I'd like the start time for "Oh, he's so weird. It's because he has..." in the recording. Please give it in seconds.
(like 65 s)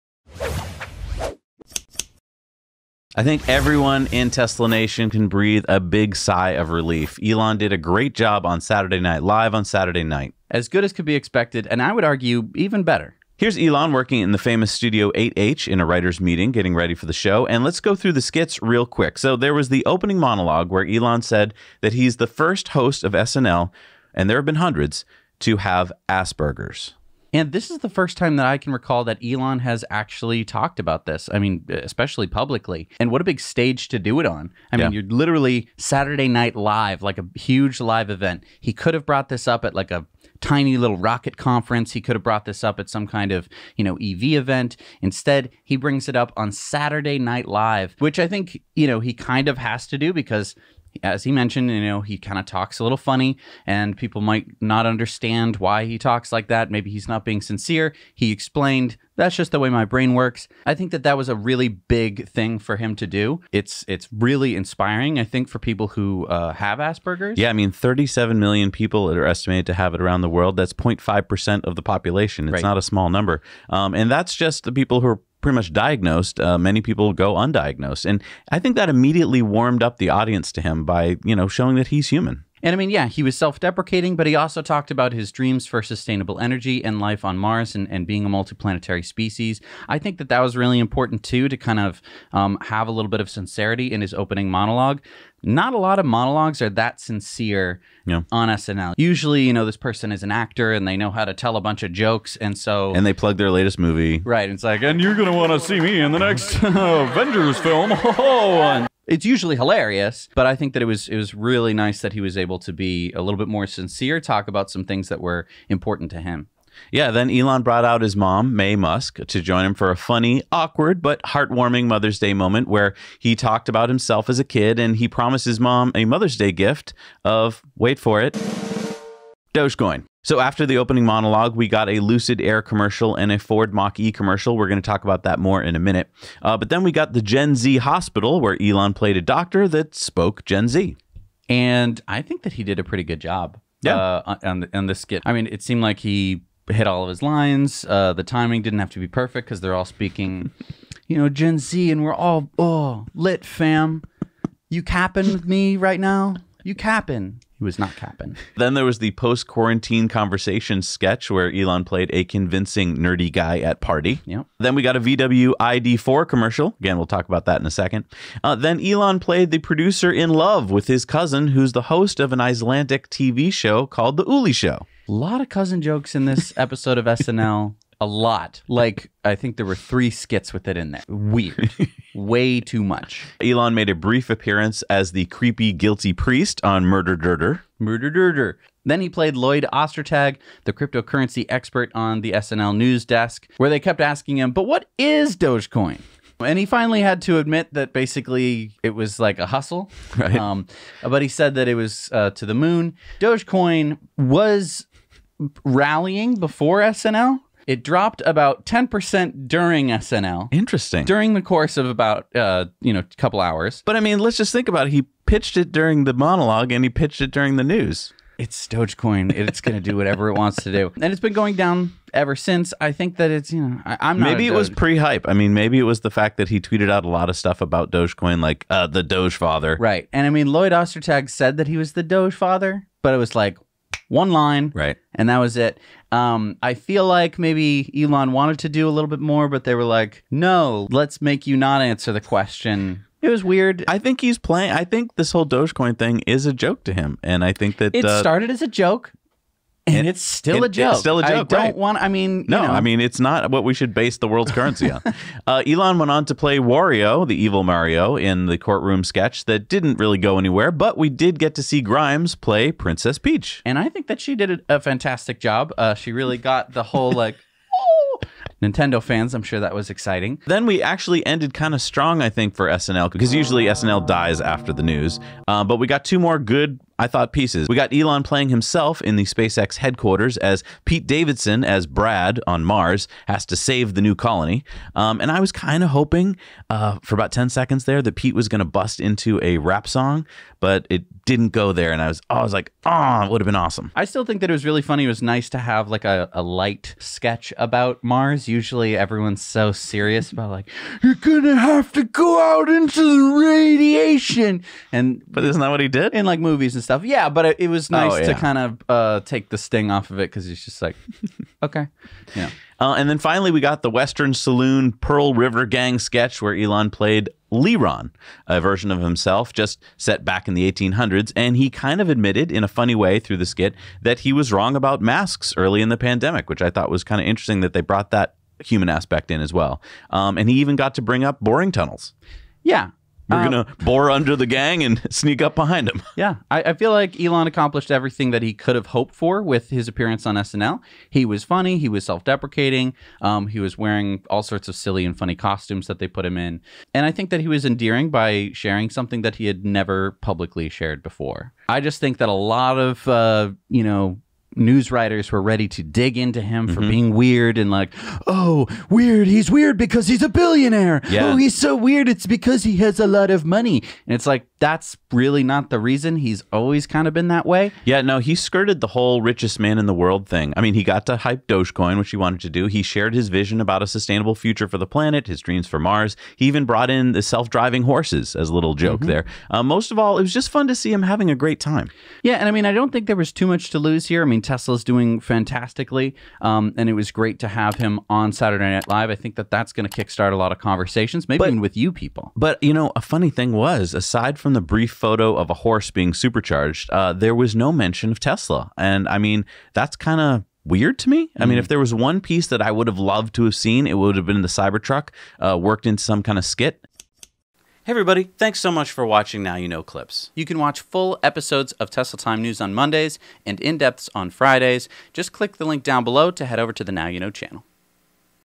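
361 s.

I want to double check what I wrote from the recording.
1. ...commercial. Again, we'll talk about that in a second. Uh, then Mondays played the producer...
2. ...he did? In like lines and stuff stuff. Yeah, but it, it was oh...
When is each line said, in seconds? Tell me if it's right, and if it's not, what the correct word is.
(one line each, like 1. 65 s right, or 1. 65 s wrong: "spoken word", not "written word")
1. 166 s wrong: "Elon", not "Mondays"
2. 305 s wrong: "movies", not "lines".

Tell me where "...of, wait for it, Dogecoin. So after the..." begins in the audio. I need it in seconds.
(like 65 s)
127 s.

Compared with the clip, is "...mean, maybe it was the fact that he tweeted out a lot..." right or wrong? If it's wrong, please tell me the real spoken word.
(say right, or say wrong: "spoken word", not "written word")
right.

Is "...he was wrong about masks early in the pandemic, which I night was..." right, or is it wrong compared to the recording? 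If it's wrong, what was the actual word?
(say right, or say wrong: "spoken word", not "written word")
wrong: "thought", not "night".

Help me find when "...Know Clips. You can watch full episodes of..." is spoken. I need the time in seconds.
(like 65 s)
409 s.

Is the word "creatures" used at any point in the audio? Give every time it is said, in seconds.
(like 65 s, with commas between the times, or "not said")
not said.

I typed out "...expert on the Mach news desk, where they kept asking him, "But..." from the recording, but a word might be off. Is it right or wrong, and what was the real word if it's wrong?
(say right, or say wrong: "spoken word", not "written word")
wrong: "SNL", not "Mach".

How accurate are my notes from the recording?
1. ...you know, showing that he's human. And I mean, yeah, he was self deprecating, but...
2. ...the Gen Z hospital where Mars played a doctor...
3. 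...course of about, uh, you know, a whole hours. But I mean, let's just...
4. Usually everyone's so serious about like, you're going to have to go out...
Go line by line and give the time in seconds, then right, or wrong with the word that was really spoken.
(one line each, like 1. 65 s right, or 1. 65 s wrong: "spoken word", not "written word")
1. 81 s right
2. 137 s wrong: "Elon", not "Mars"
3. 211 s wrong: "couple", not "whole"
4. 298 s right.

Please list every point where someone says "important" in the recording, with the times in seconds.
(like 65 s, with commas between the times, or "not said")
90 s, 115 s.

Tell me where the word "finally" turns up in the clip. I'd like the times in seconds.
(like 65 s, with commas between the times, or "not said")
196 s, 313 s.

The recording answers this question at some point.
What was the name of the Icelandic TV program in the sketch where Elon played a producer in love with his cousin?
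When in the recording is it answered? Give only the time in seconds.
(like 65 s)
174 s.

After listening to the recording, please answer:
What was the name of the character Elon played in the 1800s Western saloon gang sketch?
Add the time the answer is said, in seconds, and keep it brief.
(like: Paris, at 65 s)
Leron, at 317 s.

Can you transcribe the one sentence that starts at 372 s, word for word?
He shared his vision about a sustainable future for the planet, his dreams for Mars.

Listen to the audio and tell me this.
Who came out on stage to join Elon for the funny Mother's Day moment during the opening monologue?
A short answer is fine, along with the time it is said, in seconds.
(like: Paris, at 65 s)
Mae Musk, at 118 s.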